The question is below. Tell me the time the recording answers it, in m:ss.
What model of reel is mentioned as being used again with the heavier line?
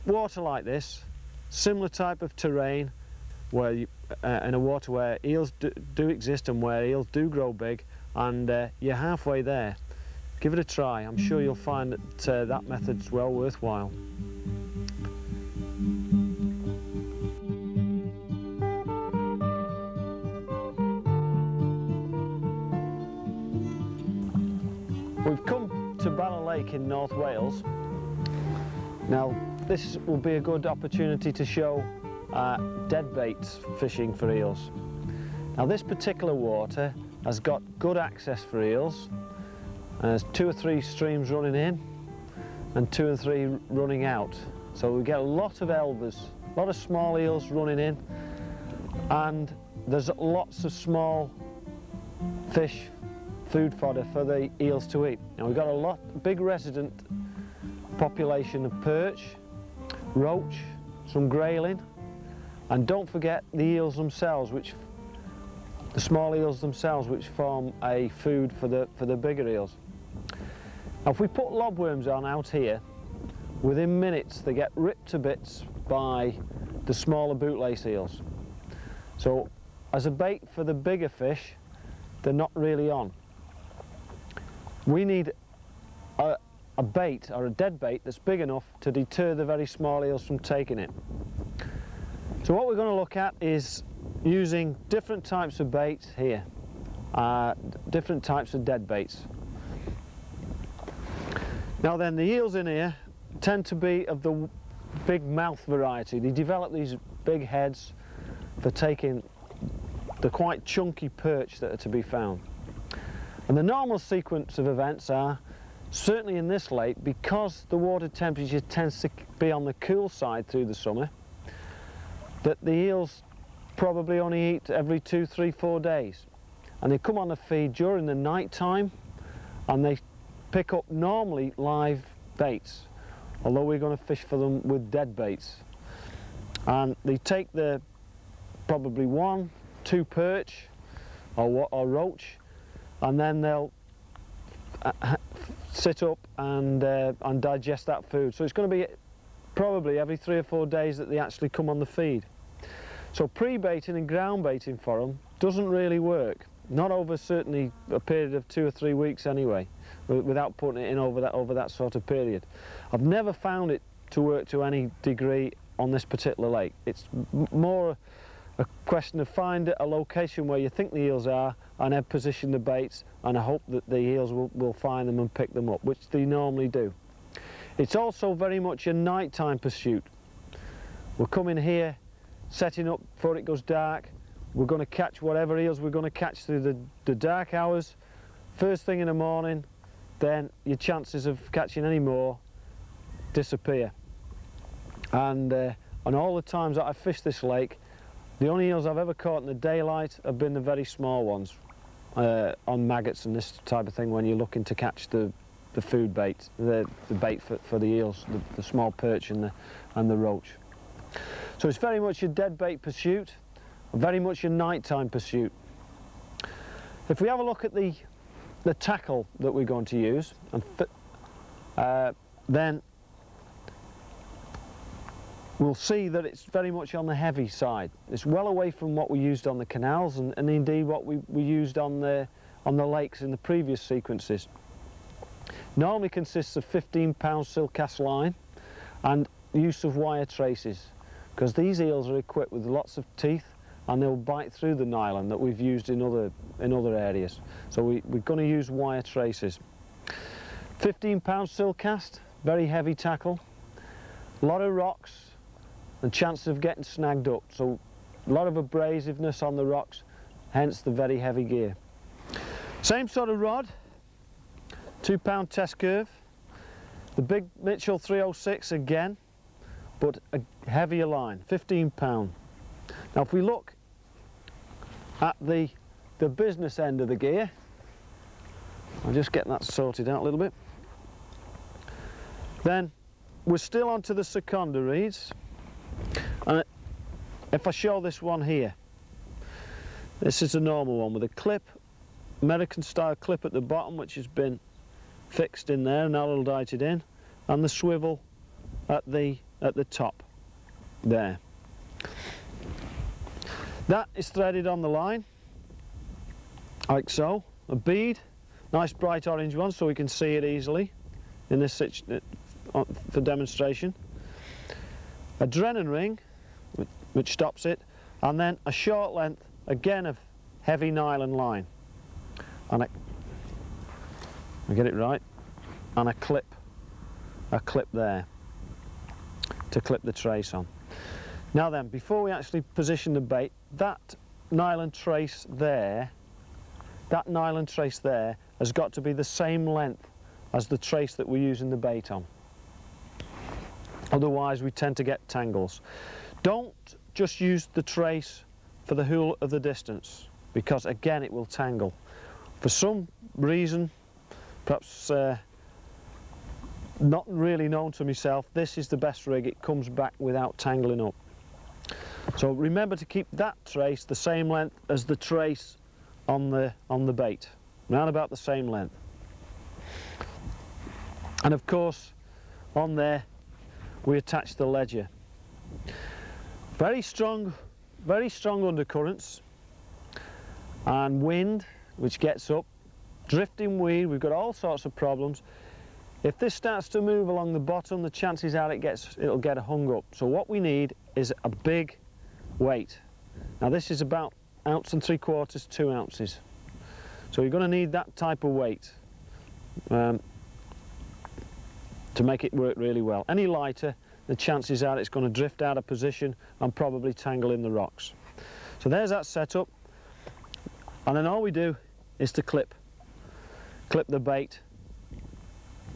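4:27.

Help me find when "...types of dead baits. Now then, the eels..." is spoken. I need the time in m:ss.
1:38.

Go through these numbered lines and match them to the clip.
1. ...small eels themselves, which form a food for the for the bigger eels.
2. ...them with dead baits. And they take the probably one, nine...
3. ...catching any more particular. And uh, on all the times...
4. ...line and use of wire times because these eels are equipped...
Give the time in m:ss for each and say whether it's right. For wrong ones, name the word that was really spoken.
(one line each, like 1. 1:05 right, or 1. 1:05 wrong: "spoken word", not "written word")
1. 1:05 right
2. 2:14 wrong: "two", not "nine"
3. 3:11 wrong: "disappear", not "particular"
4. 3:57 wrong: "traces", not "times".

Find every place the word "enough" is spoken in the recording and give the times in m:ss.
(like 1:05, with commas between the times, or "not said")
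1:28.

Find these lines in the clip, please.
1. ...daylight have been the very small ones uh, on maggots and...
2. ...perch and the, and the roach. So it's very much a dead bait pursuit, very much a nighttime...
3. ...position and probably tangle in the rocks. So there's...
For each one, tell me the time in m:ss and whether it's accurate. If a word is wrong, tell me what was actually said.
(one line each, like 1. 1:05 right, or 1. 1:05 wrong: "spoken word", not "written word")
1. 3:19 right
2. 3:28 right
3. 6:45 right.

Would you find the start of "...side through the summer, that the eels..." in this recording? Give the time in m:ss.
2:00.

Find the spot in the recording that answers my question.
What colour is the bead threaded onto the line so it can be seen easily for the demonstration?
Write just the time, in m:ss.
5:09.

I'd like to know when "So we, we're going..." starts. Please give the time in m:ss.
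4:07.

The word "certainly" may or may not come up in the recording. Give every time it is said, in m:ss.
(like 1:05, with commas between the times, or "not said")
1:55, 2:37.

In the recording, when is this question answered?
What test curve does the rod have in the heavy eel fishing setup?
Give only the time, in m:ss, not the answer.
4:25.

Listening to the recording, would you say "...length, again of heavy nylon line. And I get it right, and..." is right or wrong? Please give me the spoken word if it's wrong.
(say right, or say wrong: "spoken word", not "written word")
right.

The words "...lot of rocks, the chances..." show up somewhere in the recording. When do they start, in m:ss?
4:14.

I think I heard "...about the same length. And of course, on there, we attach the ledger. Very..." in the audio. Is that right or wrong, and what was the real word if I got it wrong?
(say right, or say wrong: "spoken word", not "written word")
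right.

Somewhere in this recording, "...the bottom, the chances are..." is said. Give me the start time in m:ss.
6:27.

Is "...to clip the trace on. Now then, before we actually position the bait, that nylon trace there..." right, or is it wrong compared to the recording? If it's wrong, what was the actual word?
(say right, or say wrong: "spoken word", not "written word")
right.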